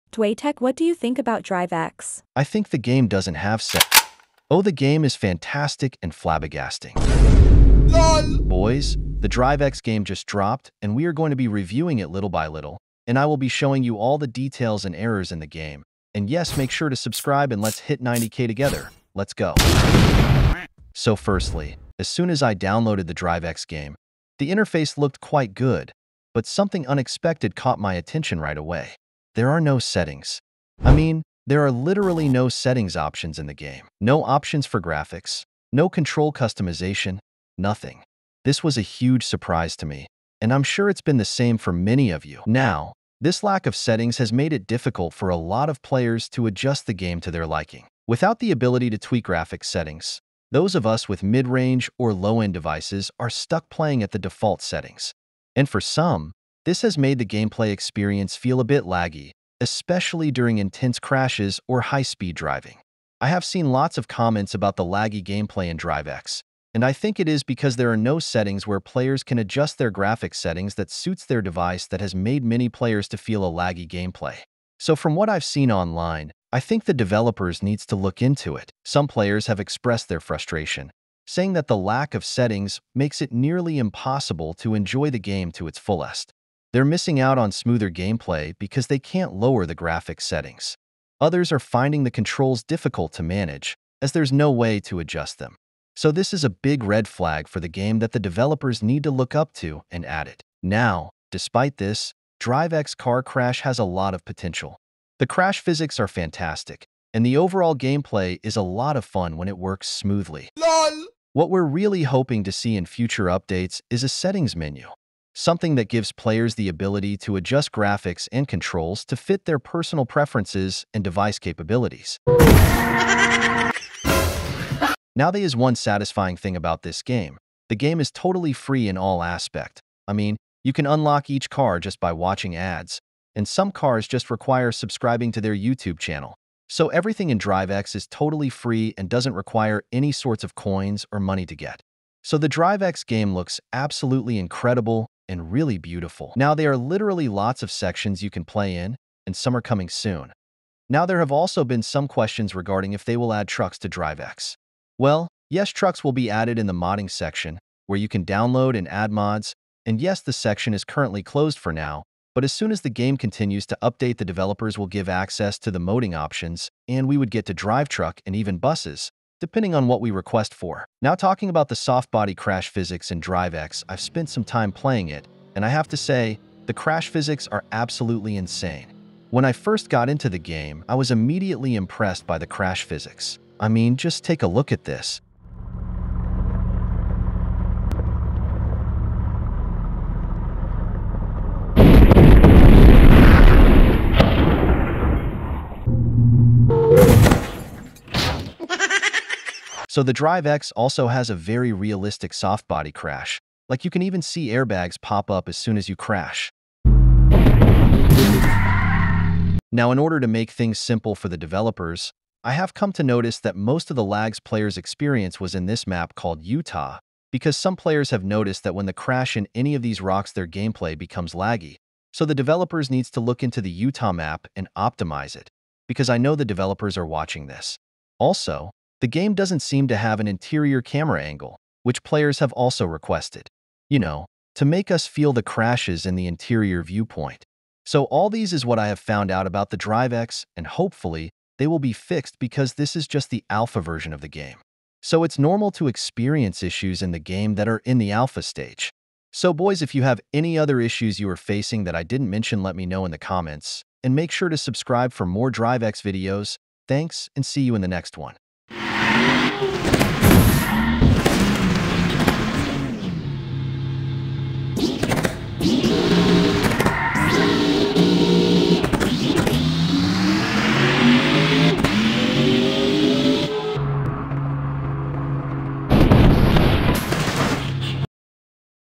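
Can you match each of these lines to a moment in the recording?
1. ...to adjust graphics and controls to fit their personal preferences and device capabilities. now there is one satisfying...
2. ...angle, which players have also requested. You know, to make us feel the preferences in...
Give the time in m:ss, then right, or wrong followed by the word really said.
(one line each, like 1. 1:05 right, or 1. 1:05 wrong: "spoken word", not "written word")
1. 1:57 right
2. 3:51 wrong: "crashes", not "preferences".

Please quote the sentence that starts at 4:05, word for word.
So it's normal to experience issues in the game that are in the alpha stage.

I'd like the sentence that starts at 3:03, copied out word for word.
I mean, just take a look at this.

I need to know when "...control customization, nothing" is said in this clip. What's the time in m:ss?
0:35.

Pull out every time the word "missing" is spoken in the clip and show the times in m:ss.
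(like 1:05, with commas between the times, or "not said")
1:26.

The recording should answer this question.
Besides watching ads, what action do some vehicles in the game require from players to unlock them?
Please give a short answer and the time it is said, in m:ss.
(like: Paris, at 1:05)
Subscribing to their YouTube channel, at 2:14.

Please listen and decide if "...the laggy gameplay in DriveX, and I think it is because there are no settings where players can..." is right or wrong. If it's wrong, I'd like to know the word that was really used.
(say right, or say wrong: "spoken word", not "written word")
right.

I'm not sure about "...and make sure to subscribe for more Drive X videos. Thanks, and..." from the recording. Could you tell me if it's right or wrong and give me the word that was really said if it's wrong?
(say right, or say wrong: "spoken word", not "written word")
right.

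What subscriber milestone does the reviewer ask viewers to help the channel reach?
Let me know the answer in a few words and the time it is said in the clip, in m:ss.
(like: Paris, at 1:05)
90k, at 0:18.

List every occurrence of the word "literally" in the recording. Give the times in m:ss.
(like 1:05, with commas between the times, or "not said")
0:31, 2:26.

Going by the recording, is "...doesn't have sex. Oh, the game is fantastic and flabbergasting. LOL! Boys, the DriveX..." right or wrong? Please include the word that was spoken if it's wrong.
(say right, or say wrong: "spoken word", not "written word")
right.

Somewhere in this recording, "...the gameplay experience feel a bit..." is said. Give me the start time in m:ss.
0:57.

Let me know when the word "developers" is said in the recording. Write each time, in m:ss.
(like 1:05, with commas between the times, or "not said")
1:16, 1:38, 2:44, 3:31, 3:42, 3:46.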